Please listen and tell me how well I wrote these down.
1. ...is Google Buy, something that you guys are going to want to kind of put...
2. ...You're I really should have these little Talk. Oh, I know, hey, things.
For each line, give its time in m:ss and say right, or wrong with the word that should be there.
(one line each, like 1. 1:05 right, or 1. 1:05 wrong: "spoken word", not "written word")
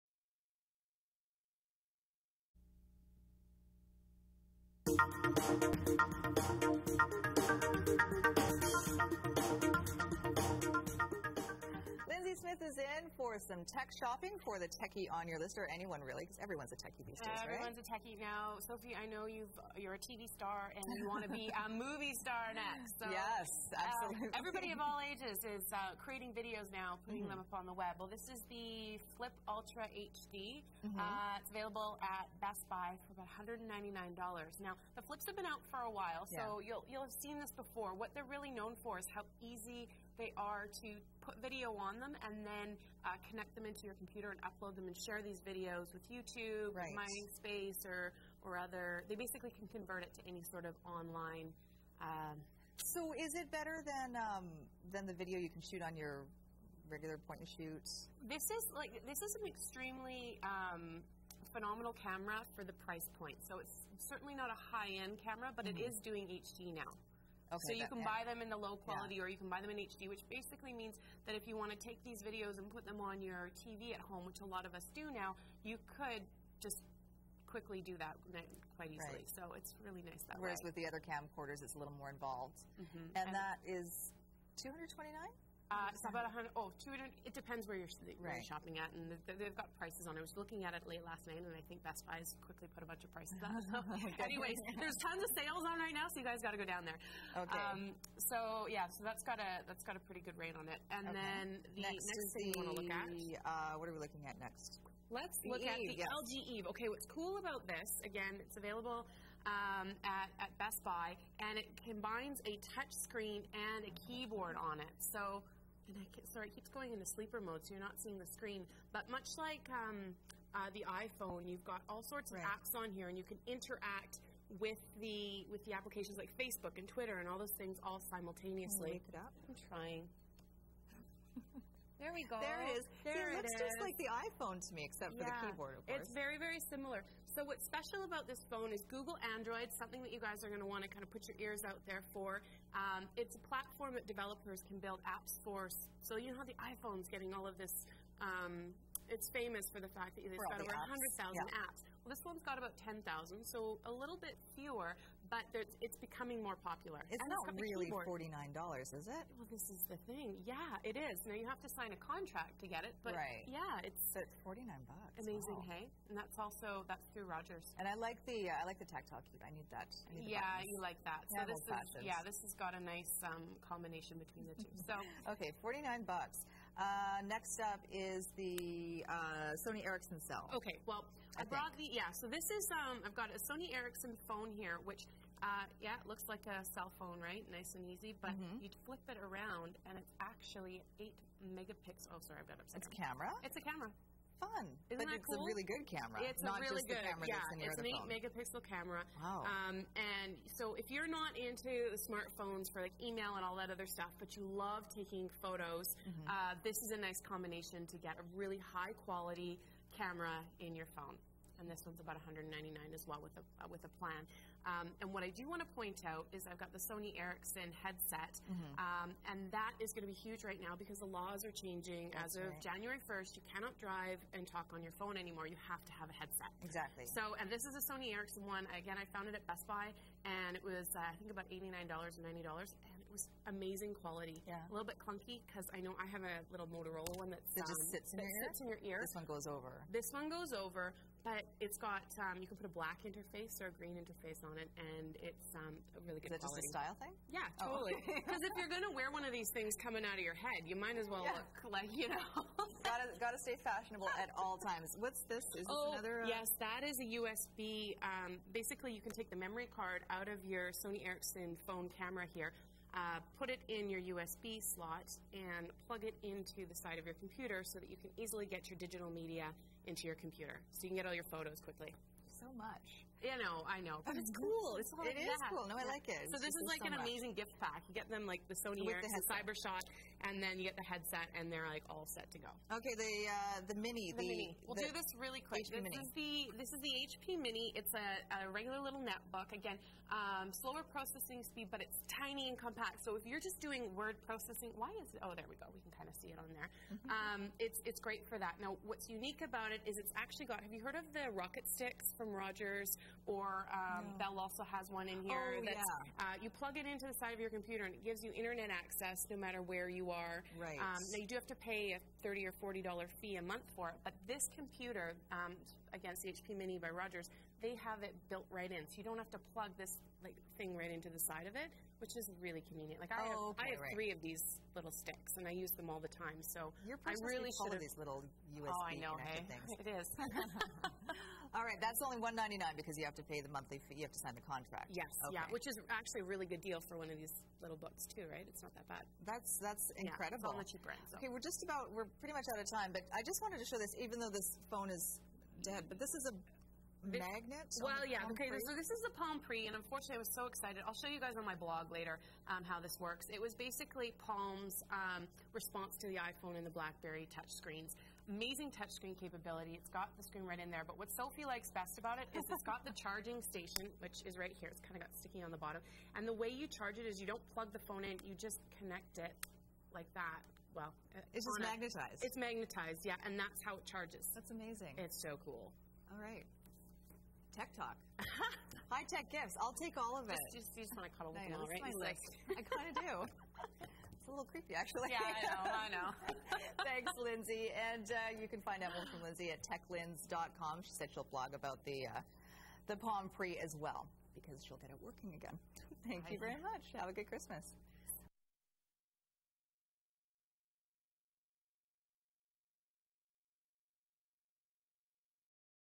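1. 2:18 wrong: "Android", not "Buy"
2. 5:26 wrong: "USB", not "Talk".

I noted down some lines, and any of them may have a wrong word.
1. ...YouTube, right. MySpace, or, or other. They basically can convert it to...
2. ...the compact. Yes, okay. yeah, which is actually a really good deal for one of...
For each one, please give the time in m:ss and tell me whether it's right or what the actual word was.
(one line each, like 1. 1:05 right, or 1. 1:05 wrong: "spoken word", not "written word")
1. 0:46 right
2. 5:34 wrong: "contract", not "compact".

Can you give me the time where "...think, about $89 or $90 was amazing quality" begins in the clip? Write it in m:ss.
3:51.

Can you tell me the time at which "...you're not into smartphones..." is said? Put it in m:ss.
3:20.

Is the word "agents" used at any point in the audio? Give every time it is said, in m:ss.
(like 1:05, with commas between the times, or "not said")
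not said.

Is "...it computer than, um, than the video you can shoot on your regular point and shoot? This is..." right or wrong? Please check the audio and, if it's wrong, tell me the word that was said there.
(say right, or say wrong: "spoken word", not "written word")
wrong: "better", not "computer".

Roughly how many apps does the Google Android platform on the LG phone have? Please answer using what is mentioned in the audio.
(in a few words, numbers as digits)
10,000.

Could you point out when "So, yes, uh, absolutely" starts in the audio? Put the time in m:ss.
0:22.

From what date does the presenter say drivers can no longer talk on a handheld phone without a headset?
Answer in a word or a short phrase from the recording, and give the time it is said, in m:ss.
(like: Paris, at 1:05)
January 1st, at 3:42.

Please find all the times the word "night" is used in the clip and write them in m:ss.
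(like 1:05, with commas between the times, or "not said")
1:31.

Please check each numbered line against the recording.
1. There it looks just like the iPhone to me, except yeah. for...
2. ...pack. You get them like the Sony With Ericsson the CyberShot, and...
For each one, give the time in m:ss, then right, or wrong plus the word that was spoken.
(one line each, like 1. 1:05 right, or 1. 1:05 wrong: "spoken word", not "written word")
1. 2:13 right
2. 4:37 right.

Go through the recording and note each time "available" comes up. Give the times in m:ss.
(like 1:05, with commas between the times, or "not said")
0:31, 1:48.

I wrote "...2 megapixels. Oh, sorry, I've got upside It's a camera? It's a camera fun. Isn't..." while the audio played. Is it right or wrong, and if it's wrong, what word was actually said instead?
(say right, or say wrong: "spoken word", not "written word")
wrong: "8", not "2".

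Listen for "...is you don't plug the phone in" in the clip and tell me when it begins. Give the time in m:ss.
6:07.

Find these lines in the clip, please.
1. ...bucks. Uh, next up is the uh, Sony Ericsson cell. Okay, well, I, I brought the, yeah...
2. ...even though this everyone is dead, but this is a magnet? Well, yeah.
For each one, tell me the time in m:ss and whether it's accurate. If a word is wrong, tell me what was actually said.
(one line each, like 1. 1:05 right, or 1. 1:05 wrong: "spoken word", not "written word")
1. 2:56 right
2. 5:43 wrong: "phone", not "everyone".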